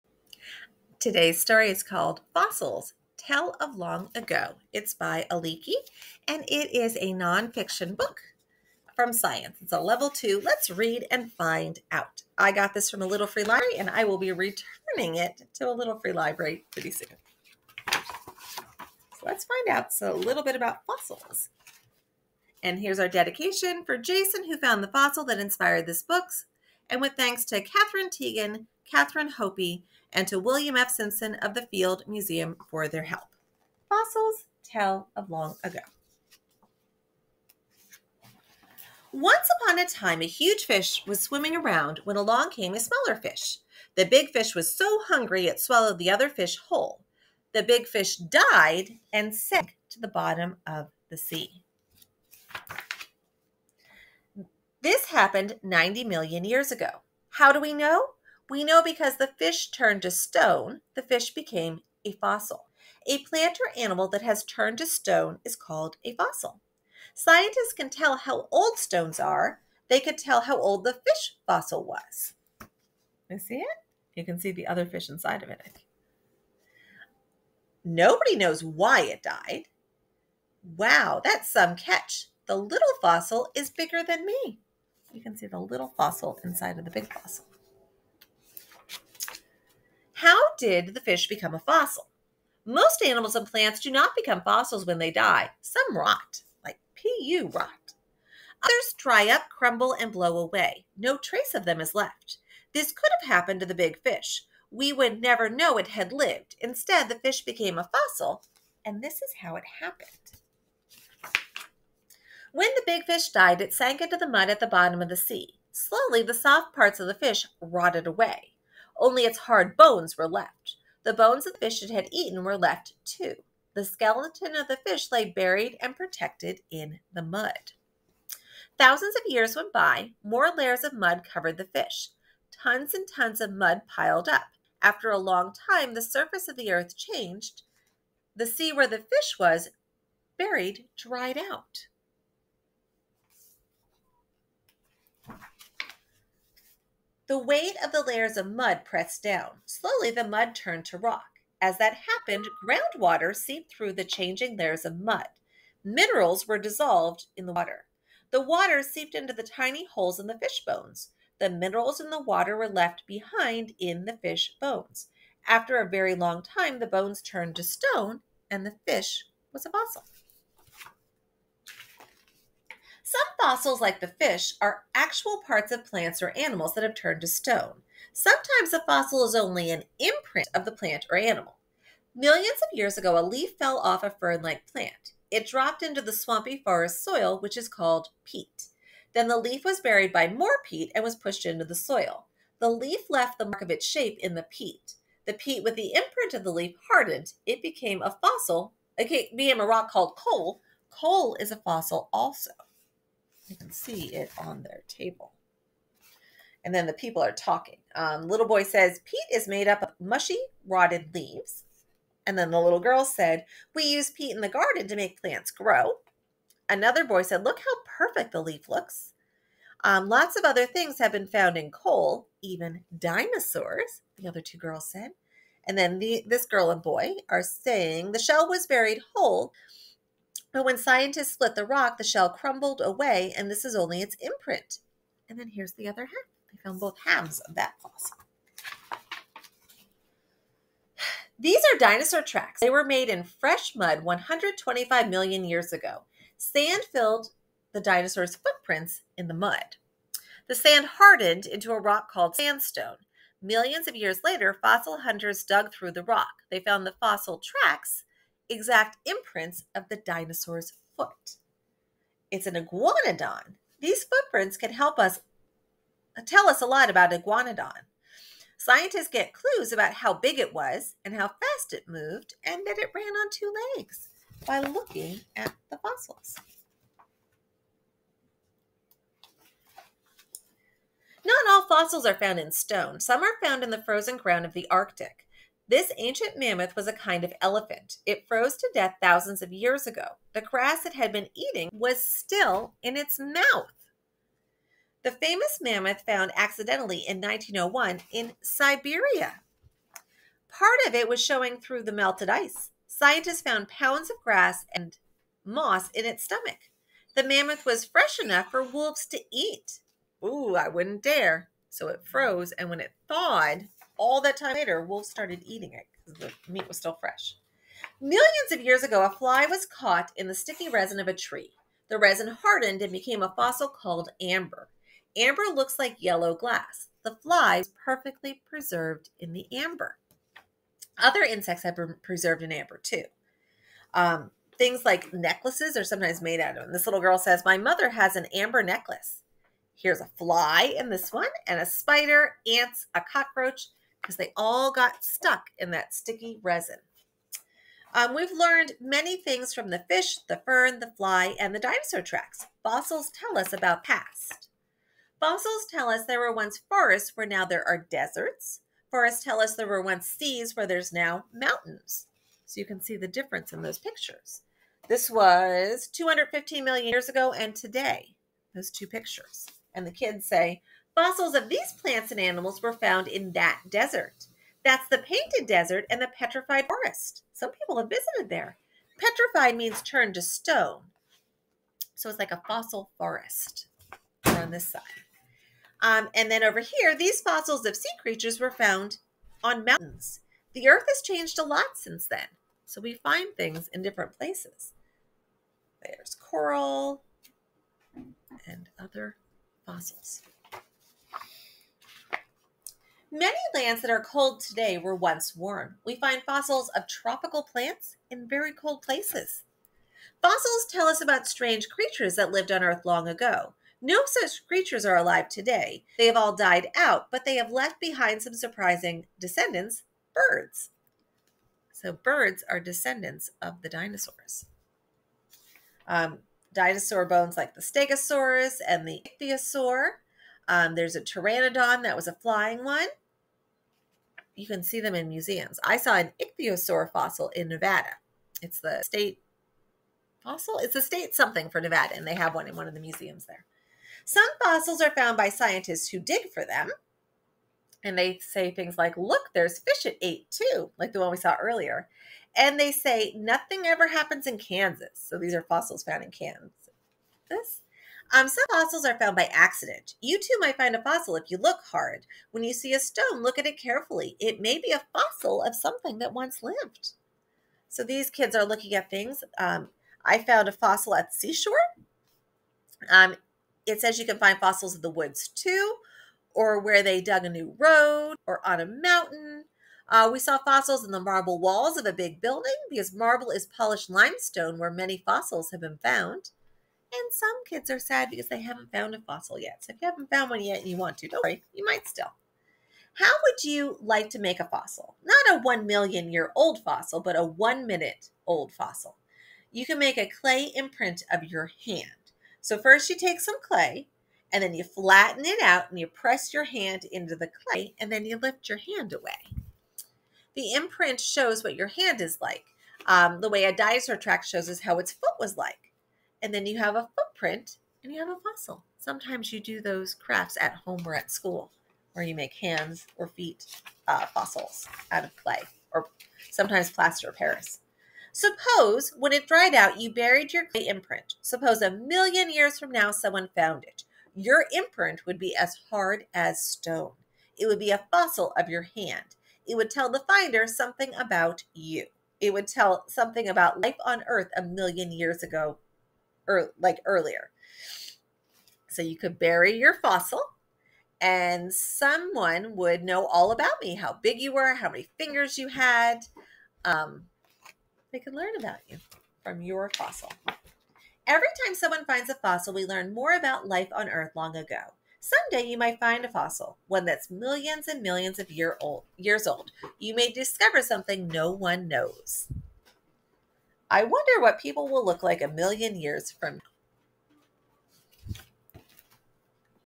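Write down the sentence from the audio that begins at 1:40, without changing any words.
No trace of them is left.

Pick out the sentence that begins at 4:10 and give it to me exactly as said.
The sand hardened into a rock called sandstone.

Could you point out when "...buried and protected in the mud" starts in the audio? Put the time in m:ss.
2:05.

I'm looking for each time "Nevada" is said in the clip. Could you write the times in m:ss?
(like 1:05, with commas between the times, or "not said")
7:17, 7:21.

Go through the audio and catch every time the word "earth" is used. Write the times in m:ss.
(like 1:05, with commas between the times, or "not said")
2:16, 6:30, 6:52, 9:04, 9:23.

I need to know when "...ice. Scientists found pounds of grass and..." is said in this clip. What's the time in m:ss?
5:02.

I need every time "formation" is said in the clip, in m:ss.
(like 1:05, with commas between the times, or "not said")
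not said.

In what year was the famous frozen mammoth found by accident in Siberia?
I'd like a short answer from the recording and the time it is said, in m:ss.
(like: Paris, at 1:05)
1901, at 4:57.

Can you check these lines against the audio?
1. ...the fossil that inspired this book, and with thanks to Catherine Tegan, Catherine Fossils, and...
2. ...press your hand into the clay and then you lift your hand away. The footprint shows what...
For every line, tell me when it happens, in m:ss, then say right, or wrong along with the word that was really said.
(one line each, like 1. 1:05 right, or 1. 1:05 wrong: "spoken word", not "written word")
1. 0:24 wrong: "Hopi", not "Fossils"
2. 8:25 wrong: "imprint", not "footprint".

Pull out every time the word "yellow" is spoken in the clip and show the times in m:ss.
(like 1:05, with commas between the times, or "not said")
5:26.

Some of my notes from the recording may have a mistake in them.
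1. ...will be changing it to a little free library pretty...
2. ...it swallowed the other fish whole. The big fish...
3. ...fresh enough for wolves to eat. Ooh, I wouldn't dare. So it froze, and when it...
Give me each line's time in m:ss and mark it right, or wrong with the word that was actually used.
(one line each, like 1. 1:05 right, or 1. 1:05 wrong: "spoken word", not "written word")
1. 0:14 wrong: "returning", not "changing"
2. 0:45 right
3. 5:07 right.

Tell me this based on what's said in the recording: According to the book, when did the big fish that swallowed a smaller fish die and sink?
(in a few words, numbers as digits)
90 million years ago.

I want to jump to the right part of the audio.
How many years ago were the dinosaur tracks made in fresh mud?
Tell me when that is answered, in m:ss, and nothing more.
4:04.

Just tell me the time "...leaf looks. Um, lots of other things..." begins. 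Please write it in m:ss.
3:38.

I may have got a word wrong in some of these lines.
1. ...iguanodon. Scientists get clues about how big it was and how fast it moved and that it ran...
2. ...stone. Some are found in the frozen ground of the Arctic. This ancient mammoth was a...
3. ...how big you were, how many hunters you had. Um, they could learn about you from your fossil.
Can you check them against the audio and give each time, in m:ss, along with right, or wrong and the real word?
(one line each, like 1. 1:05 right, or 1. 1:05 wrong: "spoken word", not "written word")
1. 4:27 right
2. 4:42 right
3. 9:13 wrong: "fingers", not "hunters".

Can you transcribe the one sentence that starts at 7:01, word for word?
So, birds are descendants of the dinosaurs.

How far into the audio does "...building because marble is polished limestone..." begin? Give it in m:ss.
8:02.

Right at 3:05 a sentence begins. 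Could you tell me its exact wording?
It dropped into the swampy forest soil, which is called peat.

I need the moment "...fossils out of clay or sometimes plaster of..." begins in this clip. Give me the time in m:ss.
8:44.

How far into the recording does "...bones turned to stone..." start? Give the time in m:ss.
2:46.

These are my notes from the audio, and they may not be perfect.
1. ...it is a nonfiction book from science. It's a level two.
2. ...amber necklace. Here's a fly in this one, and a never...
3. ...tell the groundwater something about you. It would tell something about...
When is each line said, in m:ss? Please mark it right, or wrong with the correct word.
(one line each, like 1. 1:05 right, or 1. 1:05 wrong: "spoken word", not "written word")
1. 0:06 right
2. 5:38 wrong: "spider", not "never"
3. 8:59 wrong: "finder", not "groundwater".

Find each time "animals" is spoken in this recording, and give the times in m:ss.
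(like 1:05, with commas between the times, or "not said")
1:03, 1:33, 2:56, 3:01, 6:12.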